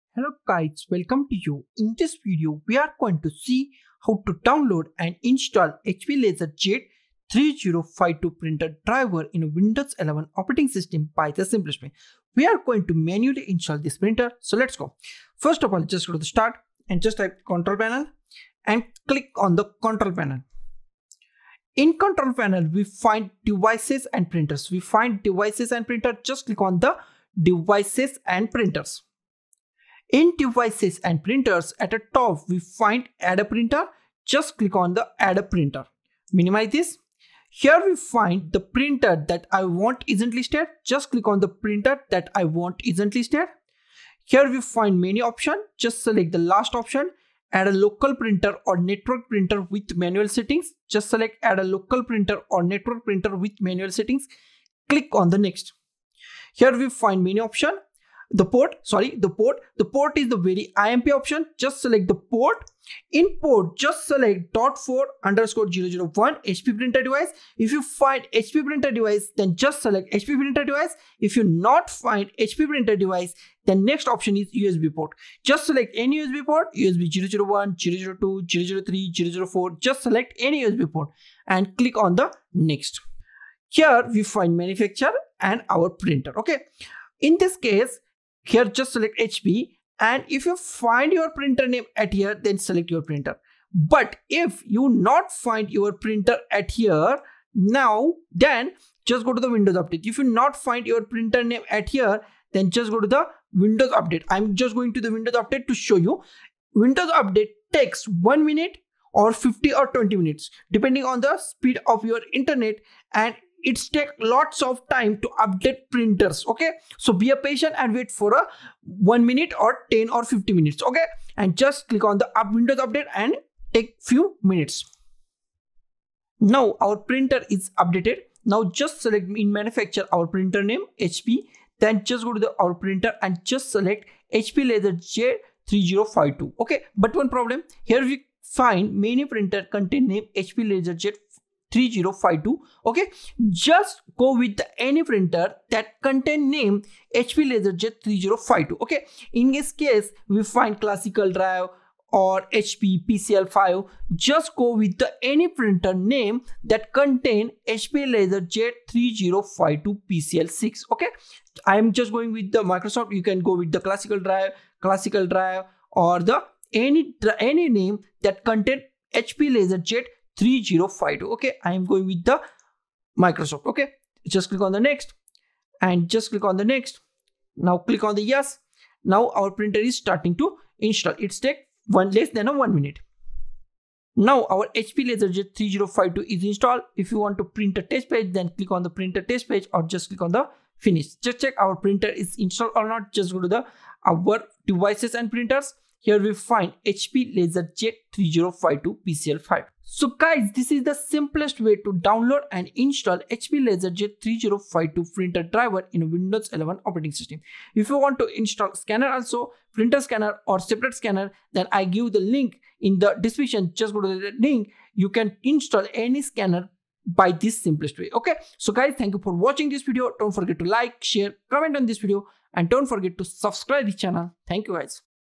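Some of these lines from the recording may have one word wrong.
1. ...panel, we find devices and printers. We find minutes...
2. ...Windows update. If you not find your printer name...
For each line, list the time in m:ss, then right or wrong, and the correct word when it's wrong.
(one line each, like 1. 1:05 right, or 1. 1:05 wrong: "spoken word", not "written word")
1. 0:22 wrong: "devices", not "minutes"
2. 1:39 right.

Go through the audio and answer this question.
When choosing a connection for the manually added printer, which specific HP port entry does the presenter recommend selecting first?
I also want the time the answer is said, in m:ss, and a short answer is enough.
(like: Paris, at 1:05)
dot4_001, at 1:04.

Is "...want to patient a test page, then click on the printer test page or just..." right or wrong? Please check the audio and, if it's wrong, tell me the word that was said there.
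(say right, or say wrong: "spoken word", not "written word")
wrong: "print", not "patient".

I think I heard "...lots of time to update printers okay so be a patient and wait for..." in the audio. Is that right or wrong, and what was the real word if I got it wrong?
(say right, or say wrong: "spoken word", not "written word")
right.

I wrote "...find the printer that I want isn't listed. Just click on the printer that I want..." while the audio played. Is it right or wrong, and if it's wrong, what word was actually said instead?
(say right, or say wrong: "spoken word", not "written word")
right.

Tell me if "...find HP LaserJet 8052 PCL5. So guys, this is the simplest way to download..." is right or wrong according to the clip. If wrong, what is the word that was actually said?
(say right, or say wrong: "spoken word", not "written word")
wrong: "3052", not "8052".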